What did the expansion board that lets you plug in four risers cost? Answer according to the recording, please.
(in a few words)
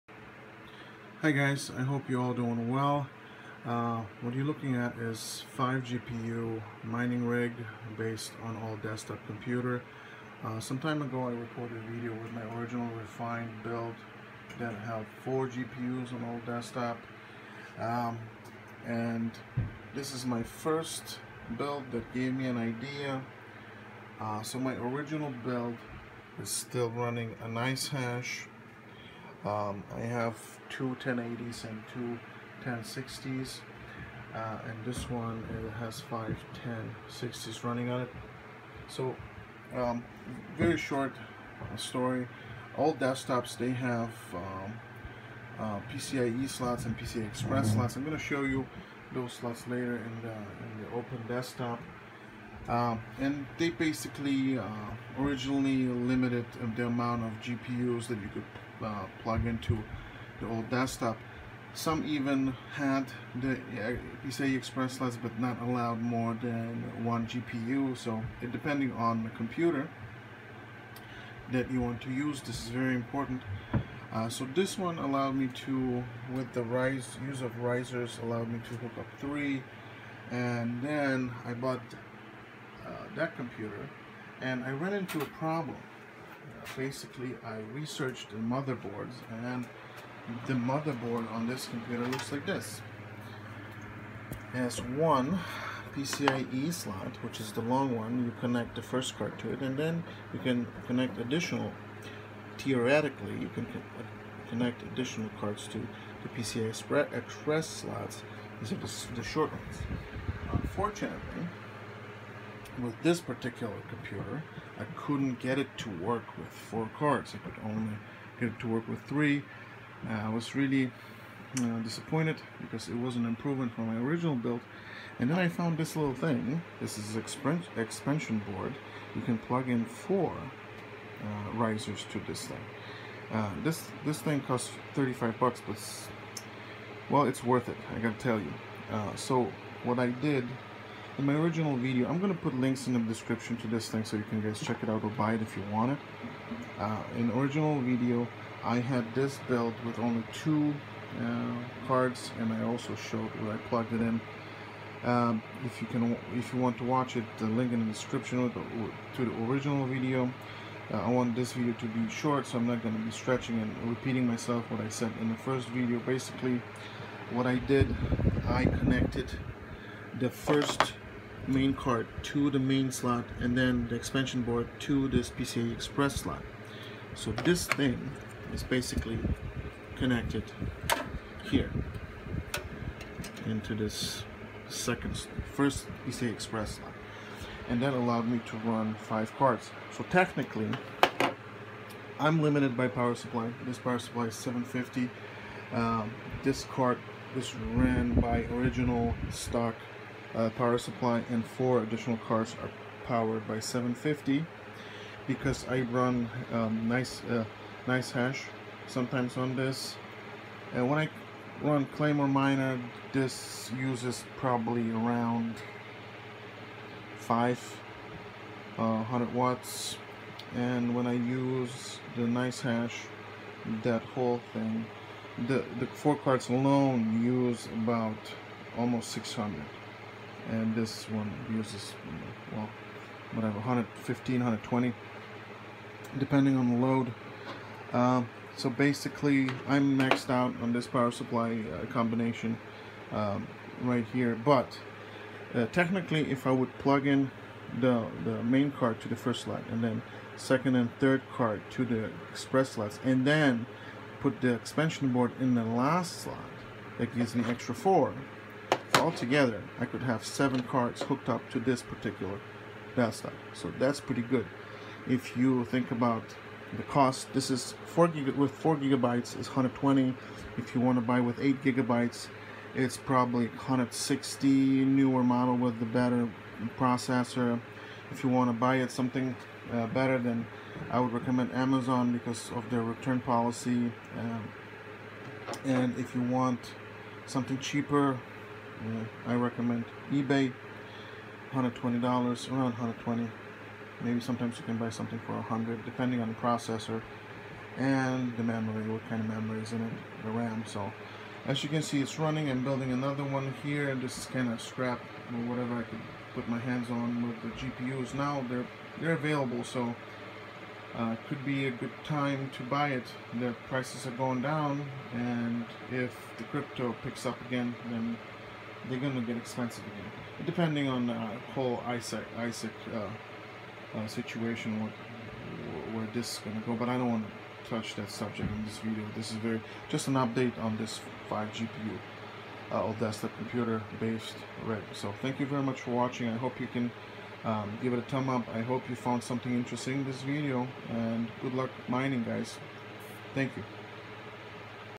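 $35.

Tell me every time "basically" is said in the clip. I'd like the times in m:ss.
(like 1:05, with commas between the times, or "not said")
0:53, 1:26, 2:45, 2:58, 3:58.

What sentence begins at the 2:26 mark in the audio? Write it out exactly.
Uh, in original video, I had this built with only two uh, cards and I also showed where I plugged it in.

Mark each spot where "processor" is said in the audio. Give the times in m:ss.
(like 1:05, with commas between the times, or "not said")
4:36, 4:56.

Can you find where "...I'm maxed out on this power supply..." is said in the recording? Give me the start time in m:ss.
3:59.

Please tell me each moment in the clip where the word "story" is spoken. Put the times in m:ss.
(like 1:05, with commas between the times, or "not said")
0:41.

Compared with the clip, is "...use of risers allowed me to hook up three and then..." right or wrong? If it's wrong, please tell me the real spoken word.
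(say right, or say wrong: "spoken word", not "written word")
right.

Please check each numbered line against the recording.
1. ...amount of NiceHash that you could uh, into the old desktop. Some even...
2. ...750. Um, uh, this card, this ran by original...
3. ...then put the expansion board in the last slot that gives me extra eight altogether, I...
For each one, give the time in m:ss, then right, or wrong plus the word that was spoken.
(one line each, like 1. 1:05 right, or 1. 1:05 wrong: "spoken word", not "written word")
1. 0:56 wrong: "GPUs", not "NiceHash"
2. 3:14 right
3. 4:13 wrong: "four", not "eight".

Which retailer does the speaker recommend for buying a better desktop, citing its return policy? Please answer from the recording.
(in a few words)
Amazon.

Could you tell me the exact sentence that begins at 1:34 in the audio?
It has one PCIe slot, which is the long one.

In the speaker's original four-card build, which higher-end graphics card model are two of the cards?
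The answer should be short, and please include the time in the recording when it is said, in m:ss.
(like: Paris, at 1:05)
1080, at 0:31.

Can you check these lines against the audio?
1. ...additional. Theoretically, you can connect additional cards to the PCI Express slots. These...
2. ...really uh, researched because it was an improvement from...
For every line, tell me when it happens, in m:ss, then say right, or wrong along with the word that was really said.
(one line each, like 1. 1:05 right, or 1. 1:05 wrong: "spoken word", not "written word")
1. 1:41 right
2. 2:00 wrong: "disappointed", not "researched".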